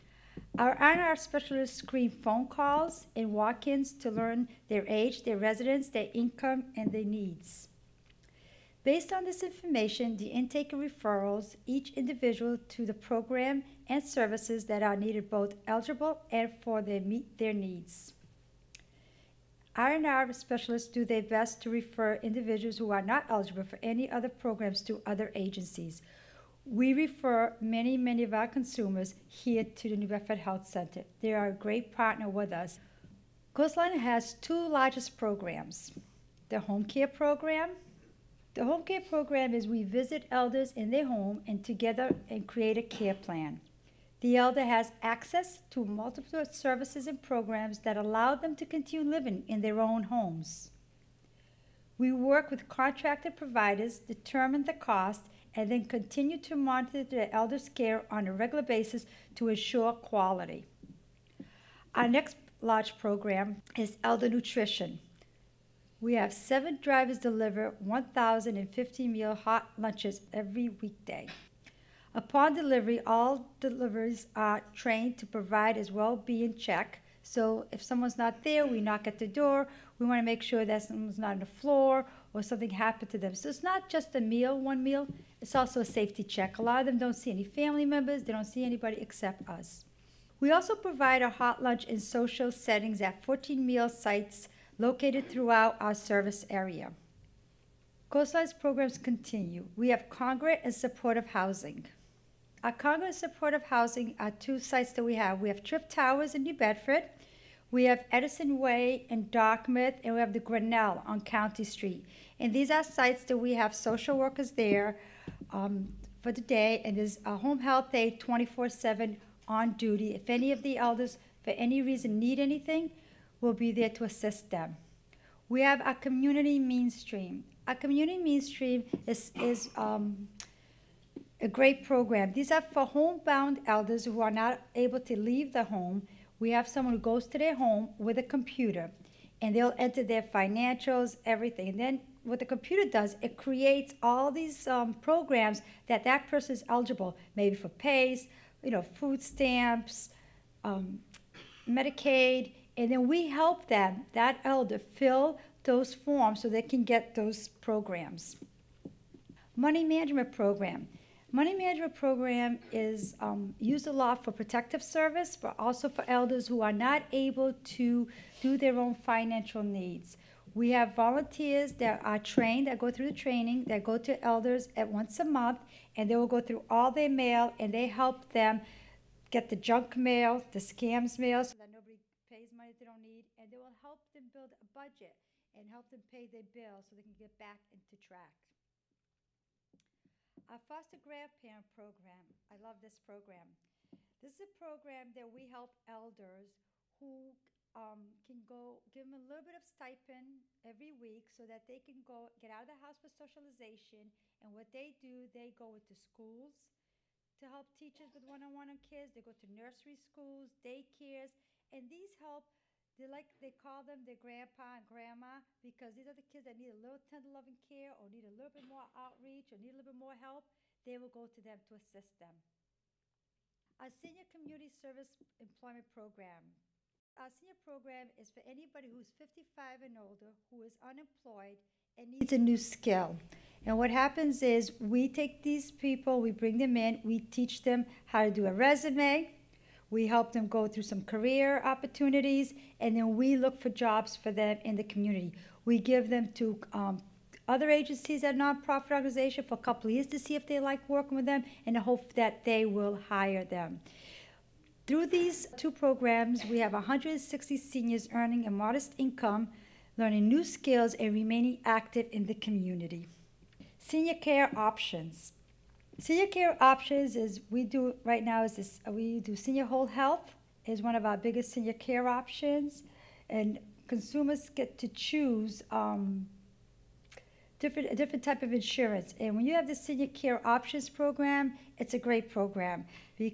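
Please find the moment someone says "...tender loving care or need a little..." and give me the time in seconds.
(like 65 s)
216 s.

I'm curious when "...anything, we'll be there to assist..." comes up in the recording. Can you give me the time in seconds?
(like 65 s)
122 s.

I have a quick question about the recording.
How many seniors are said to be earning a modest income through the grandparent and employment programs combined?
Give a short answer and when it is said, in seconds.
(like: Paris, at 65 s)
160, at 256 s.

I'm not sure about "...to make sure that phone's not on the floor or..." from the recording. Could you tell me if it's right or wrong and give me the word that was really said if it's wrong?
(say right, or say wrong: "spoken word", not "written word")
wrong: "someone", not "phone".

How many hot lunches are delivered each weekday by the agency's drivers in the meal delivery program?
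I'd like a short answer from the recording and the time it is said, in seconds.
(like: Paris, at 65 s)
1,050, at 67 s.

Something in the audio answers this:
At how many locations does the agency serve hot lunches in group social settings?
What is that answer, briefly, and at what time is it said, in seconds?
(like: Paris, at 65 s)
14, at 93 s.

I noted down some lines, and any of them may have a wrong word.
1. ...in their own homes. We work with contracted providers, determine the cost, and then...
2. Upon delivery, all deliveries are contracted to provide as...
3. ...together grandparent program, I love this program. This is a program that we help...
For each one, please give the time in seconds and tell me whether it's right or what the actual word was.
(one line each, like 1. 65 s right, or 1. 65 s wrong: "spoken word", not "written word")
1. 49 s right
2. 72 s wrong: "trained", not "contracted"
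3. 190 s wrong: "foster", not "together".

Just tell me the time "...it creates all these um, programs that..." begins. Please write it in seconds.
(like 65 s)
143 s.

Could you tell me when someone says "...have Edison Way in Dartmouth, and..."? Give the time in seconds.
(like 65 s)
107 s.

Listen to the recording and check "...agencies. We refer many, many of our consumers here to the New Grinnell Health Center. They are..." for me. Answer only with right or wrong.
wrong.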